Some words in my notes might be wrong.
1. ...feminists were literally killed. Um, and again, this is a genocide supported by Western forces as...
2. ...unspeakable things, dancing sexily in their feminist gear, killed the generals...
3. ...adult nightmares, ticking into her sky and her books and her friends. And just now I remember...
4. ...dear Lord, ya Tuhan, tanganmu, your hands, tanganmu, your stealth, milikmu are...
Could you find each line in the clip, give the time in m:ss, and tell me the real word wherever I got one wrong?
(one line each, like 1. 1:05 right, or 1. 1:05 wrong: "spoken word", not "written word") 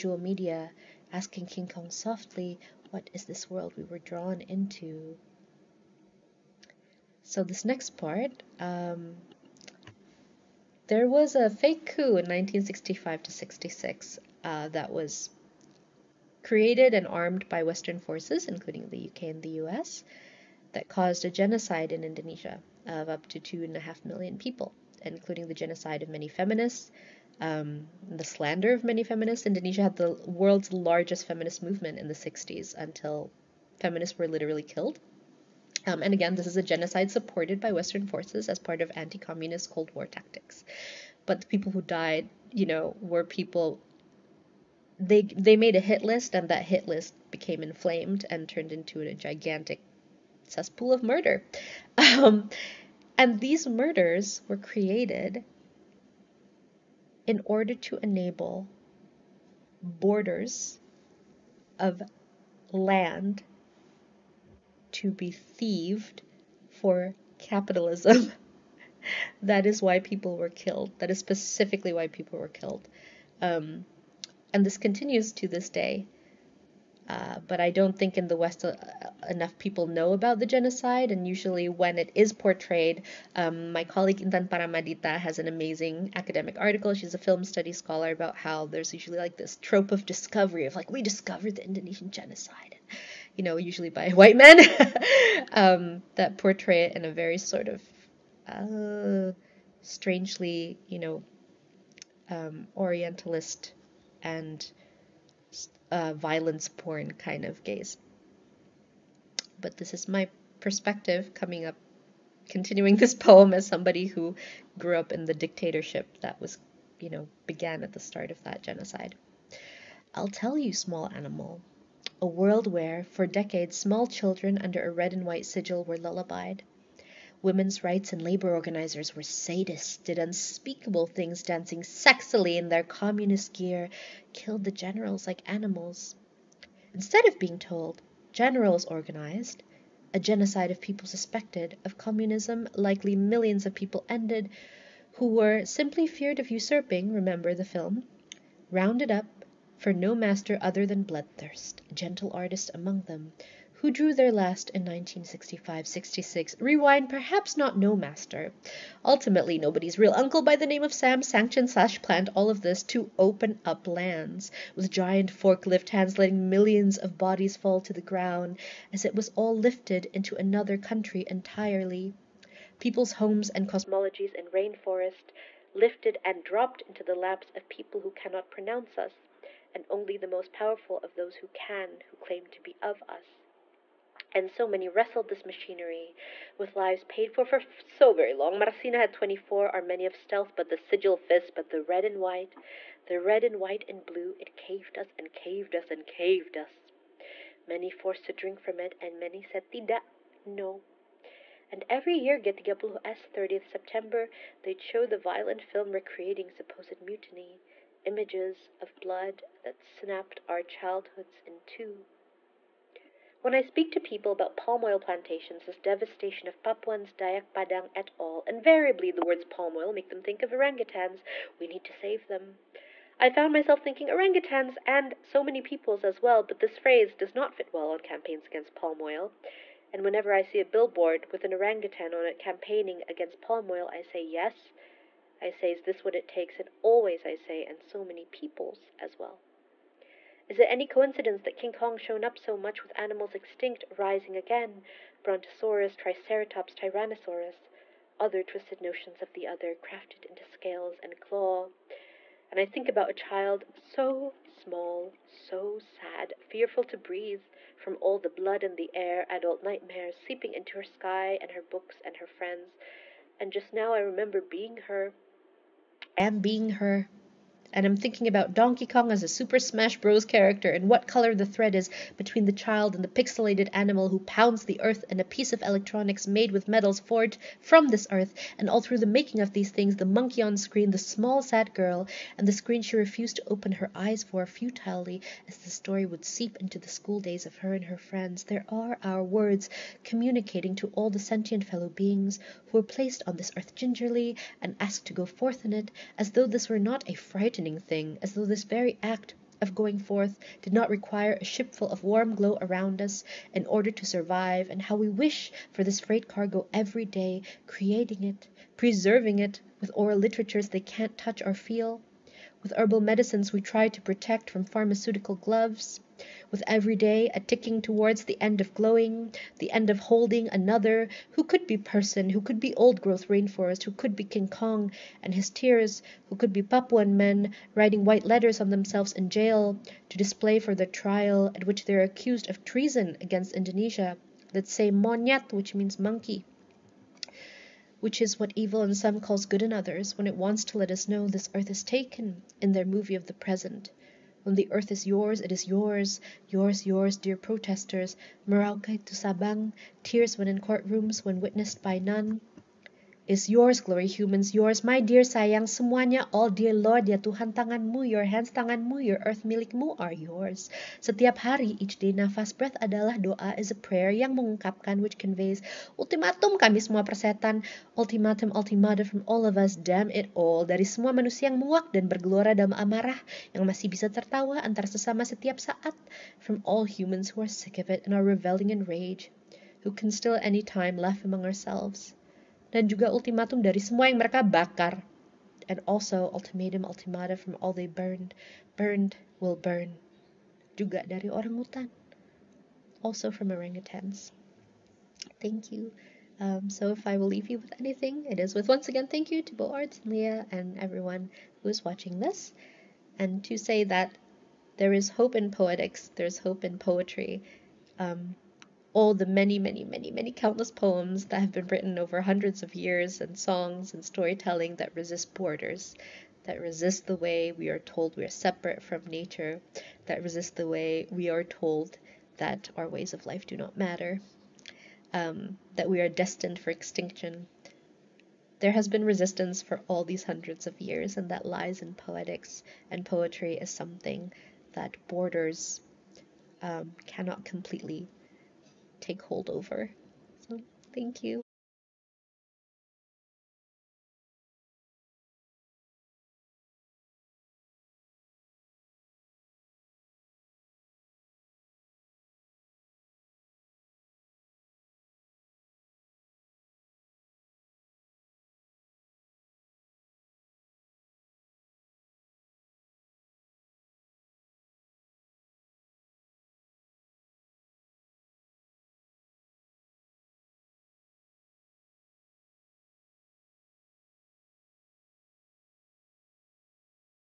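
1. 0:33 right
2. 2:10 wrong: "communist", not "feminist"
3. 4:19 wrong: "seeping", not "ticking"
4. 5:56 wrong: "earth", not "stealth".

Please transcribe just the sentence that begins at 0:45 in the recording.
They, they made a hit list, and that hit list became inflamed and turned into a gigantic cesspool of murder.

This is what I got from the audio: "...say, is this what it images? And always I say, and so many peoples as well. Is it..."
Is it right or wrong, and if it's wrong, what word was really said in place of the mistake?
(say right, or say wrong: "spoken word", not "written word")
wrong: "takes", not "images".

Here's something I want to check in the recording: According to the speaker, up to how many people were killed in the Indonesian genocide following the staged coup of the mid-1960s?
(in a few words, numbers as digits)
2.5 million.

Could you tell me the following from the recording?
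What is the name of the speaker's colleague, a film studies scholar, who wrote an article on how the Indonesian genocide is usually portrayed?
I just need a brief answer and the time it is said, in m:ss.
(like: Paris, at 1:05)
Intan Paramaditha, at 1:24.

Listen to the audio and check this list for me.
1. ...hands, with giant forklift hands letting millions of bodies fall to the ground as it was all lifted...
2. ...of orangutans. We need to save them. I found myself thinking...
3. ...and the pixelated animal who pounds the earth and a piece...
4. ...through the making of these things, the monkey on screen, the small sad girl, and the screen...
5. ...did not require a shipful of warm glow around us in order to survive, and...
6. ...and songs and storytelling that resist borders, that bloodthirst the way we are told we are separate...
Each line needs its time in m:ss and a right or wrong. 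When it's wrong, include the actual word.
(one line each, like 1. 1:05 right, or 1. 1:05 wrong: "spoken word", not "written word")
1. 2:43 wrong: "lands", not "hands"
2. 3:40 right
3. 4:32 right
4. 4:38 right
5. 5:00 right
6. 6:53 wrong: "resist", not "bloodthirst".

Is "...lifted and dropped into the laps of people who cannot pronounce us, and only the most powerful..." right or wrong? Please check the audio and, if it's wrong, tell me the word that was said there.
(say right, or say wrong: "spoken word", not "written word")
right.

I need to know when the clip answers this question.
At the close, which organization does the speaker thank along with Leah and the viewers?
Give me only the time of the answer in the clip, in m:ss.
6:39.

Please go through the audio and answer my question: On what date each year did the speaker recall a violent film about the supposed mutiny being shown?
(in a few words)
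30th September.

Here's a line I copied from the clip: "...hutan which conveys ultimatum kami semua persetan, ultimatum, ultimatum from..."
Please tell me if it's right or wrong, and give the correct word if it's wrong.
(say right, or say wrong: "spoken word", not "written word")
wrong: "mengungkapkan", not "hutan".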